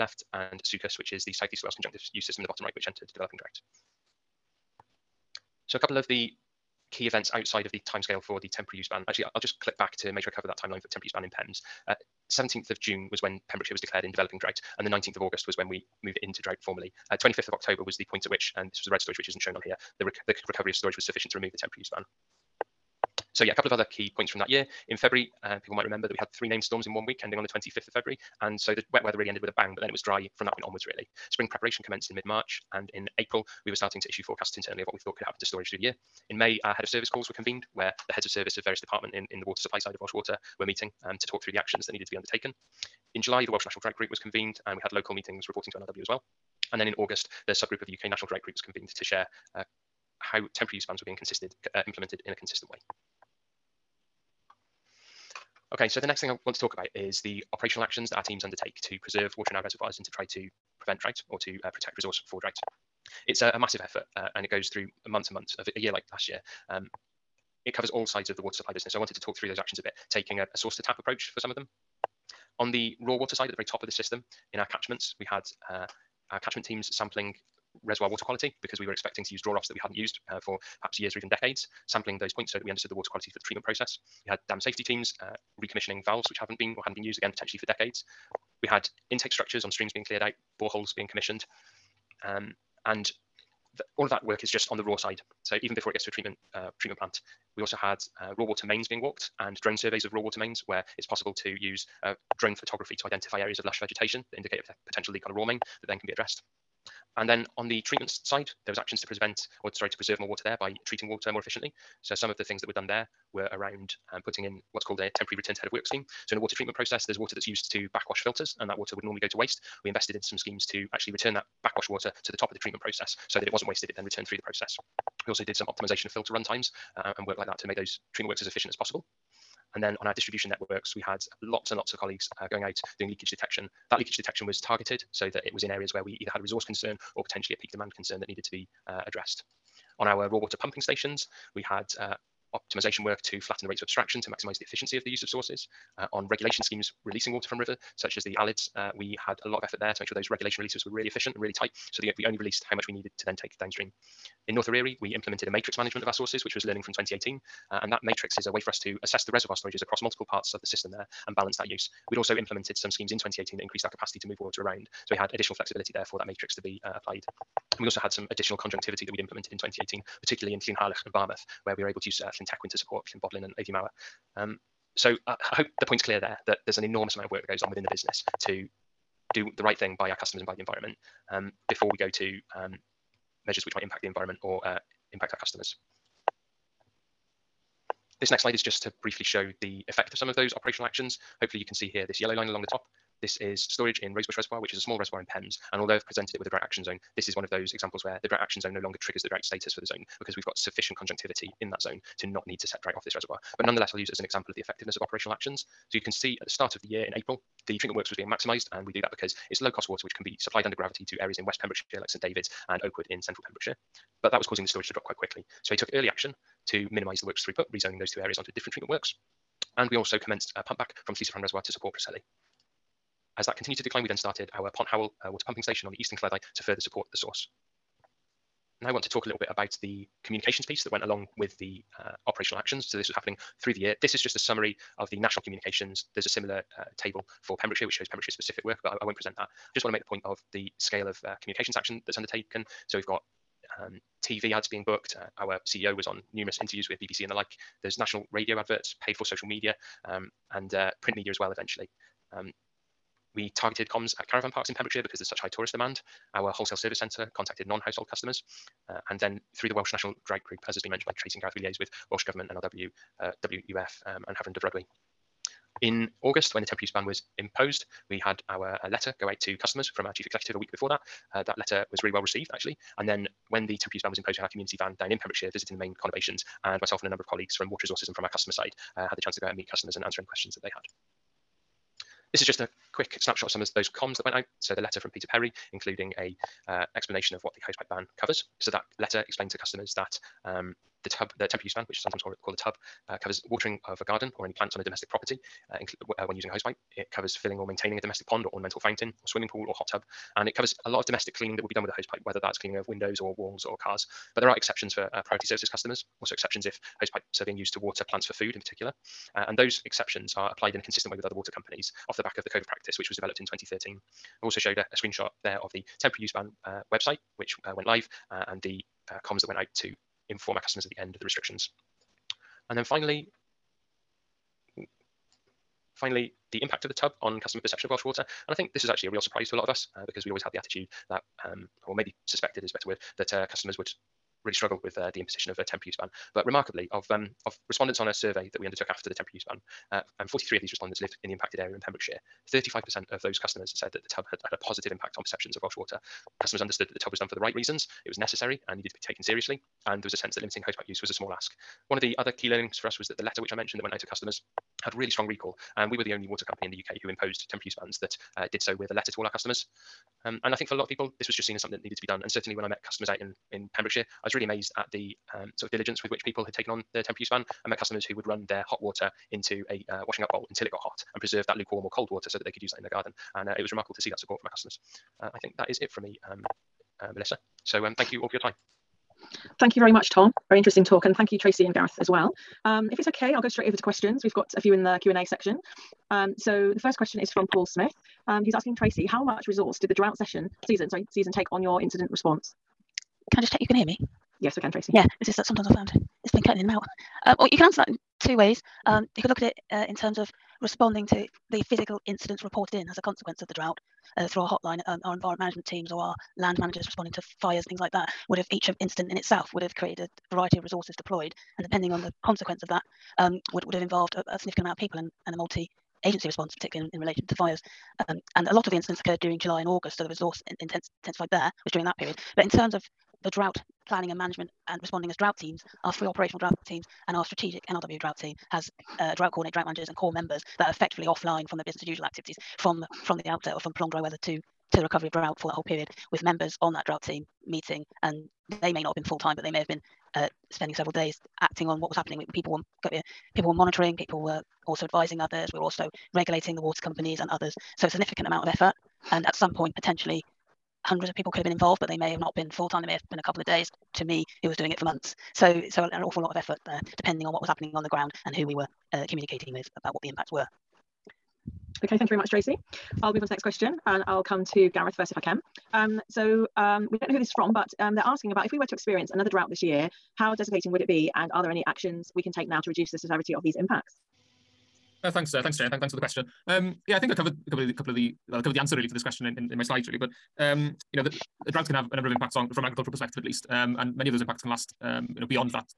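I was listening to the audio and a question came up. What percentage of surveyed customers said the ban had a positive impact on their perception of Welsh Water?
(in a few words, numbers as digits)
35%.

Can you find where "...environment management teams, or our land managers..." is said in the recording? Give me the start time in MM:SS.
06:45.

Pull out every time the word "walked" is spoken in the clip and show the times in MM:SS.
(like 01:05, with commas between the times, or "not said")
01:39.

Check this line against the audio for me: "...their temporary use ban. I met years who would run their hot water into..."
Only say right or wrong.
wrong.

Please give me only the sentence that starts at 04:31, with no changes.
Uh, that letter was really well received, actually.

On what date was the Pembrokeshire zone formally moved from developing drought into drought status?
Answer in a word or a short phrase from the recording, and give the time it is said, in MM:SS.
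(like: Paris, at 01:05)
19th of August, at 00:14.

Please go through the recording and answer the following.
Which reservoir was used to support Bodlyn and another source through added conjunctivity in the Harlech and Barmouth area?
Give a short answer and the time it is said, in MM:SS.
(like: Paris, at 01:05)
Llyn Tecwyn, at 02:52.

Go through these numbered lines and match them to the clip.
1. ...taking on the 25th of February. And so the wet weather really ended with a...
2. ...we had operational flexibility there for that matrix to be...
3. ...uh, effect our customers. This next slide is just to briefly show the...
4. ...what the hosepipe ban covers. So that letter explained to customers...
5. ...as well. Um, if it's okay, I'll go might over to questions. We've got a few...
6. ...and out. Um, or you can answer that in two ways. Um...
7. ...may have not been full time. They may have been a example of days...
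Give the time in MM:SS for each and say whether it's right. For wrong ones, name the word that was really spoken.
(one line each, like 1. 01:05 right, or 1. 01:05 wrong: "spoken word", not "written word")
1. 00:27 wrong: "ending", not "taking"
2. 02:45 wrong: "additional", not "operational"
3. 03:04 wrong: "impact", not "effect"
4. 04:47 right
5. 06:21 wrong: "straight", not "might"
6. 06:36 right
7. 07:31 wrong: "couple", not "example".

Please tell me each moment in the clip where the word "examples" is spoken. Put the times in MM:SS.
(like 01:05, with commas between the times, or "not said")
03:17, 03:24.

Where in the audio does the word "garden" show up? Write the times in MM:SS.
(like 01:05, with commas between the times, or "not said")
04:54, 06:12.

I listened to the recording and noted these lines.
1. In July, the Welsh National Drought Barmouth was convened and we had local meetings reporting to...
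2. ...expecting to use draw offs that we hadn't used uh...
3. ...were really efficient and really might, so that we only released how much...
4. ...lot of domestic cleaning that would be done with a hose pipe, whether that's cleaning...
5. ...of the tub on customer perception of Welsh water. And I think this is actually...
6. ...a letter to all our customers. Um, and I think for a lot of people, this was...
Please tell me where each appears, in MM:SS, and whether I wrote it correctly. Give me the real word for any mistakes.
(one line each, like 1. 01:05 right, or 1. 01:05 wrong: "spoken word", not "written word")
1. 00:43 wrong: "Group", not "Barmouth"
2. 01:18 right
3. 02:30 wrong: "tight", not "might"
4. 05:00 right
5. 05:26 right
6. 05:58 right.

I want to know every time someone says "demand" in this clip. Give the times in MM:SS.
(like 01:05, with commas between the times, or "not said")
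02:17, 04:15.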